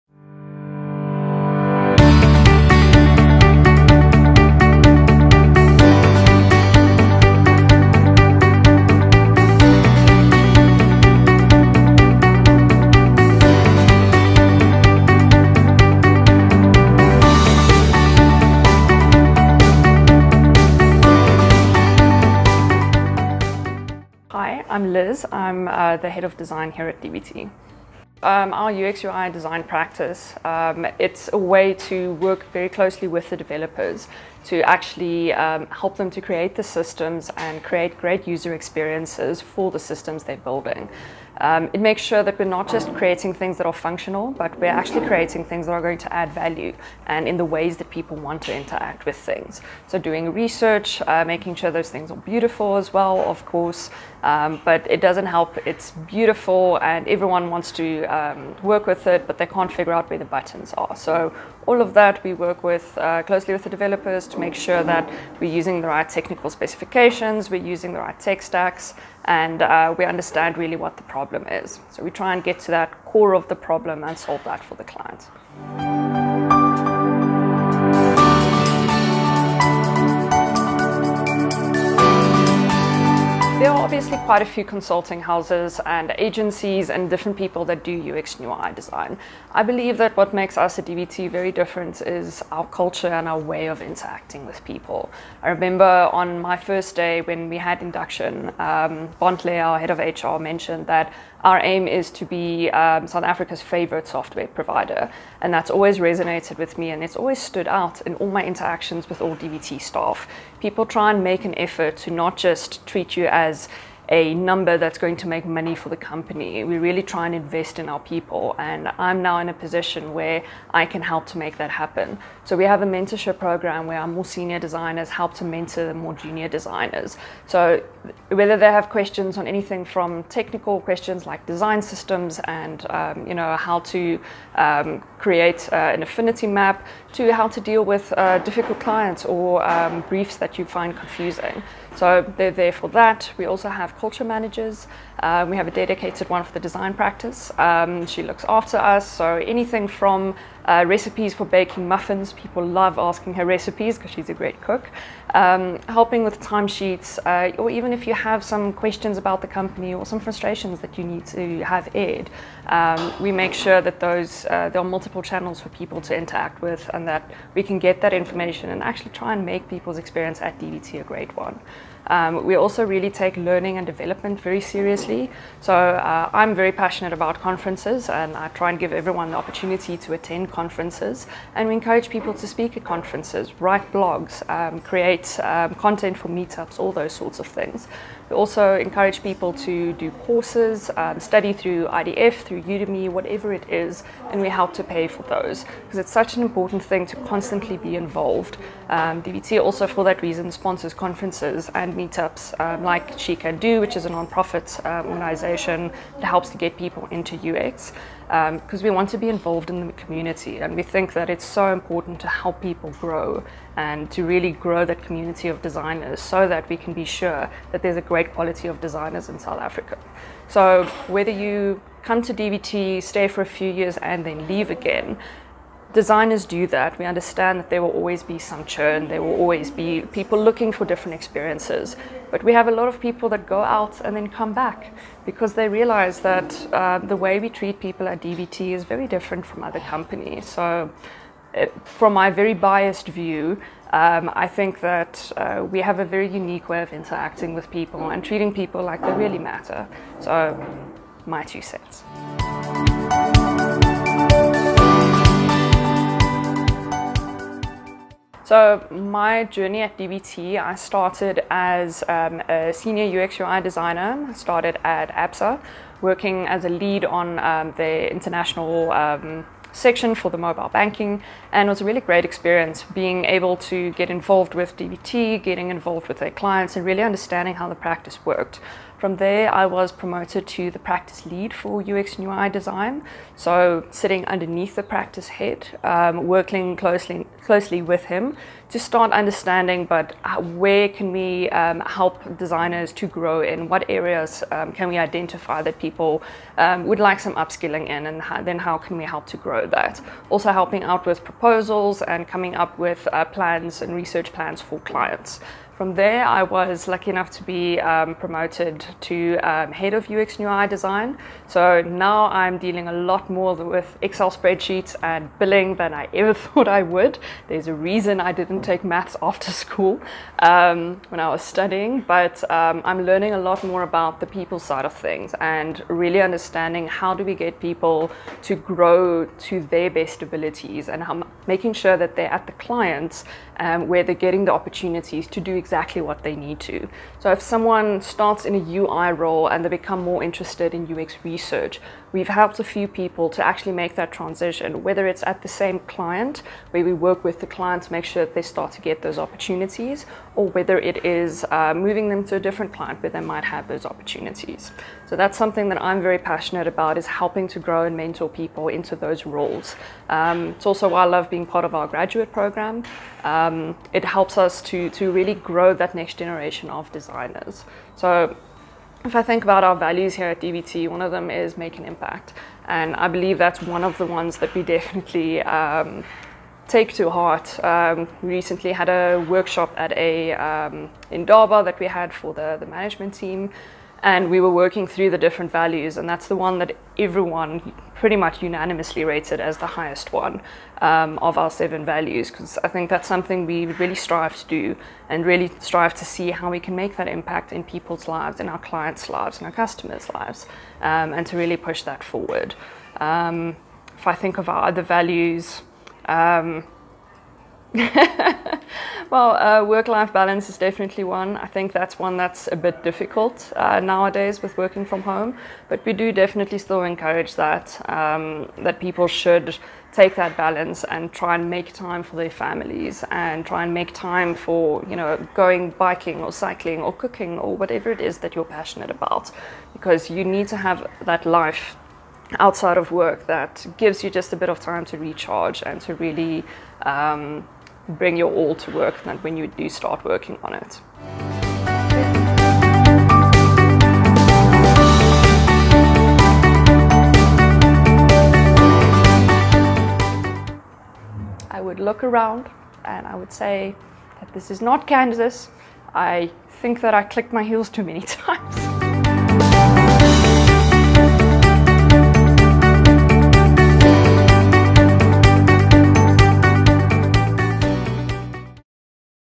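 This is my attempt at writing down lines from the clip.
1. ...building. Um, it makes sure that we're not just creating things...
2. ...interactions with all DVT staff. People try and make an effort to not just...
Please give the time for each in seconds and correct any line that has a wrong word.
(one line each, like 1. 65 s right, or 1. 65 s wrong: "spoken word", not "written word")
1. 40 s right
2. 108 s right.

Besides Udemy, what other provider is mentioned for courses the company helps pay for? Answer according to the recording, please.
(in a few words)
IDF.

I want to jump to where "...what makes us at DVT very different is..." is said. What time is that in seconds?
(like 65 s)
90 s.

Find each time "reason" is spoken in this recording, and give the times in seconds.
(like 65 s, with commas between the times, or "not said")
200 s, 317 s.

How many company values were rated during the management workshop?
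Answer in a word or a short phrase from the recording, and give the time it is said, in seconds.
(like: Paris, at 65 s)
7, at 391 s.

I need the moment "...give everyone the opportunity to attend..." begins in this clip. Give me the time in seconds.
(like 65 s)
178 s.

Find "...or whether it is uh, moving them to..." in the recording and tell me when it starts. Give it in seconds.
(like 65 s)
350 s.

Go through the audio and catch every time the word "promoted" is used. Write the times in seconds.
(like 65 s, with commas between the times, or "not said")
279 s, 308 s.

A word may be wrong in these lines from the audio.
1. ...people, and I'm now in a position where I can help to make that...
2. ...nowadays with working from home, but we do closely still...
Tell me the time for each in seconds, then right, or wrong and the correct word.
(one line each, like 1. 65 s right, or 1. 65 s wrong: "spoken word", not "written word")
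1. 118 s right
2. 413 s wrong: "definitely", not "closely".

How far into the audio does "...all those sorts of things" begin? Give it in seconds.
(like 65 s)
186 s.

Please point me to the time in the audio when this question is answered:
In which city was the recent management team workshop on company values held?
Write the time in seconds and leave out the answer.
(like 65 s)
381 s.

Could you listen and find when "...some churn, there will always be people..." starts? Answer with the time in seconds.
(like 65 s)
228 s.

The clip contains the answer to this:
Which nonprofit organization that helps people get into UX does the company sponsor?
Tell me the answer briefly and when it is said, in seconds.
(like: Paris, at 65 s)
She Can Do, at 203 s.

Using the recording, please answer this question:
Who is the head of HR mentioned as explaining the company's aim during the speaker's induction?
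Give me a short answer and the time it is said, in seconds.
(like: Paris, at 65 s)
Bontle, at 99 s.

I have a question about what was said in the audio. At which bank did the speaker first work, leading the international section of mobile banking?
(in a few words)
ABSA.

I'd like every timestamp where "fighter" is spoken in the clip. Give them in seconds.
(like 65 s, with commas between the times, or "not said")
not said.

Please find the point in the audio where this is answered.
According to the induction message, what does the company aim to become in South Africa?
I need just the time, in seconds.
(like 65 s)
103 s.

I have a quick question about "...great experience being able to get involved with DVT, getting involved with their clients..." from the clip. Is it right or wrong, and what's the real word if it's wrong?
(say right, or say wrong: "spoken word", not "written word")
right.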